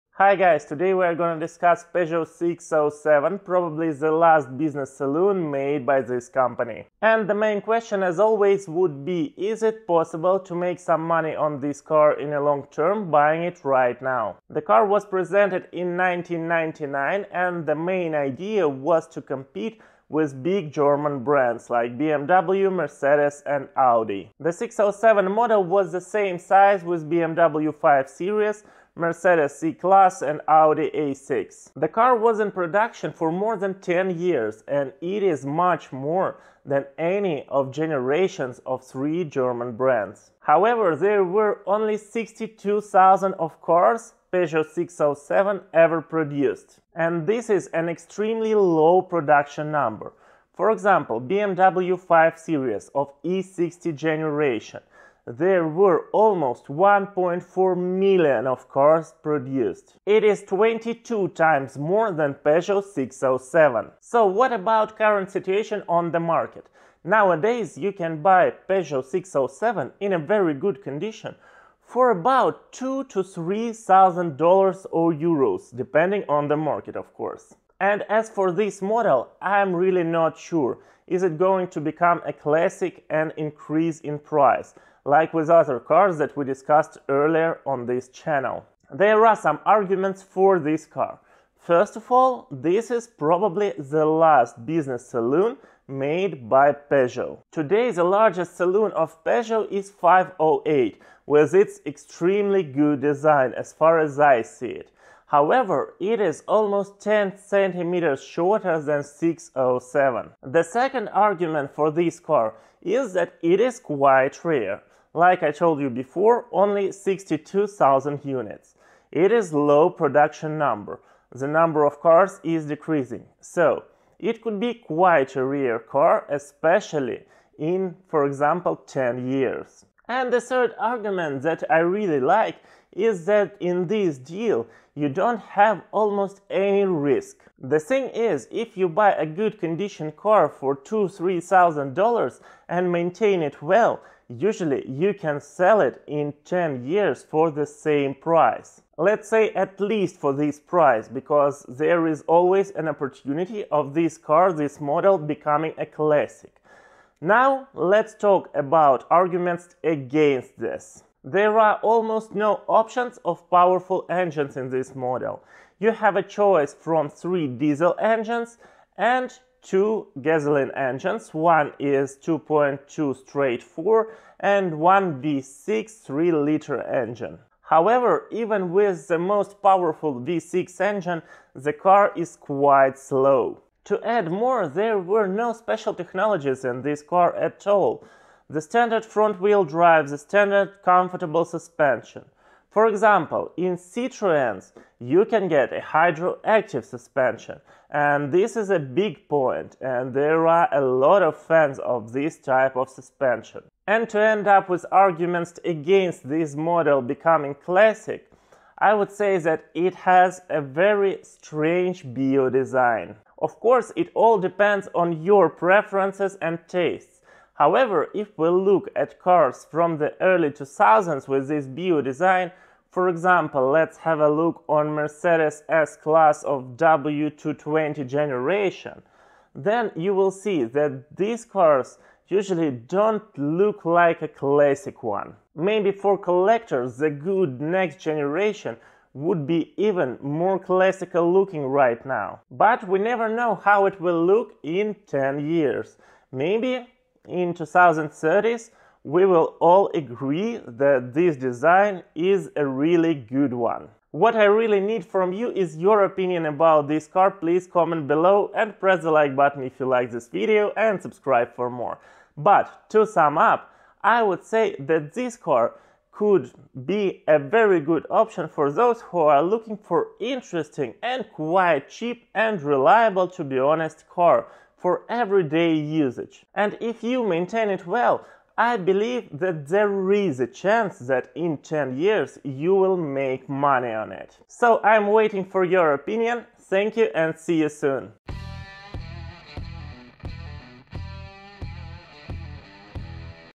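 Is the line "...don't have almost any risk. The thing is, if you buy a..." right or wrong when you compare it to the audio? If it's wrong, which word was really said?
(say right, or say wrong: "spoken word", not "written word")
right.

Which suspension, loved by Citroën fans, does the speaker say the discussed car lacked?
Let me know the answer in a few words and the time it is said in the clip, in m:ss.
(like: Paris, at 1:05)
hydroactive suspension, at 3:15.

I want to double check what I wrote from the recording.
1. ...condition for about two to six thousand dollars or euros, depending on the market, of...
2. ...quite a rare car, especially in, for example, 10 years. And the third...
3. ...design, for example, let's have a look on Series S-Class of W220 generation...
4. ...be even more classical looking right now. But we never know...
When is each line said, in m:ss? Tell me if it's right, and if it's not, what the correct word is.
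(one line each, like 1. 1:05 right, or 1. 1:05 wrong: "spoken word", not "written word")
1. 1:10 wrong: "three", not "six"
2. 2:04 right
3. 3:42 wrong: "Mercedes", not "Series"
4. 3:59 right.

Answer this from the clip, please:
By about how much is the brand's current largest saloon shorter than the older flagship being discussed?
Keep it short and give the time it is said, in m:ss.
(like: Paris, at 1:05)
10 centimeters, at 1:46.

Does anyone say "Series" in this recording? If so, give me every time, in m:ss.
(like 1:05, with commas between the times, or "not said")
0:28, 0:52.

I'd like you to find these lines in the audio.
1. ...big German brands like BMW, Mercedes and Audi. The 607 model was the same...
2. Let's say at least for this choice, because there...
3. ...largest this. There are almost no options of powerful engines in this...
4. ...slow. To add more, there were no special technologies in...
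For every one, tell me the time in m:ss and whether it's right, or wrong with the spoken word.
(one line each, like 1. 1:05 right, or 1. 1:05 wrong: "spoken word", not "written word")
1. 0:20 right
2. 2:28 wrong: "price", not "choice"
3. 2:39 wrong: "against", not "largest"
4. 3:02 right.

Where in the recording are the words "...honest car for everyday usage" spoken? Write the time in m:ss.
4:33.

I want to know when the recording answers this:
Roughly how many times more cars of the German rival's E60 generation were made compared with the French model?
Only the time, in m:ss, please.
1:00.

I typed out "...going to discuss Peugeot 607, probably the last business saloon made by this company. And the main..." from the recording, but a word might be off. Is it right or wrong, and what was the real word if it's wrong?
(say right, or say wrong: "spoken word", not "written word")
right.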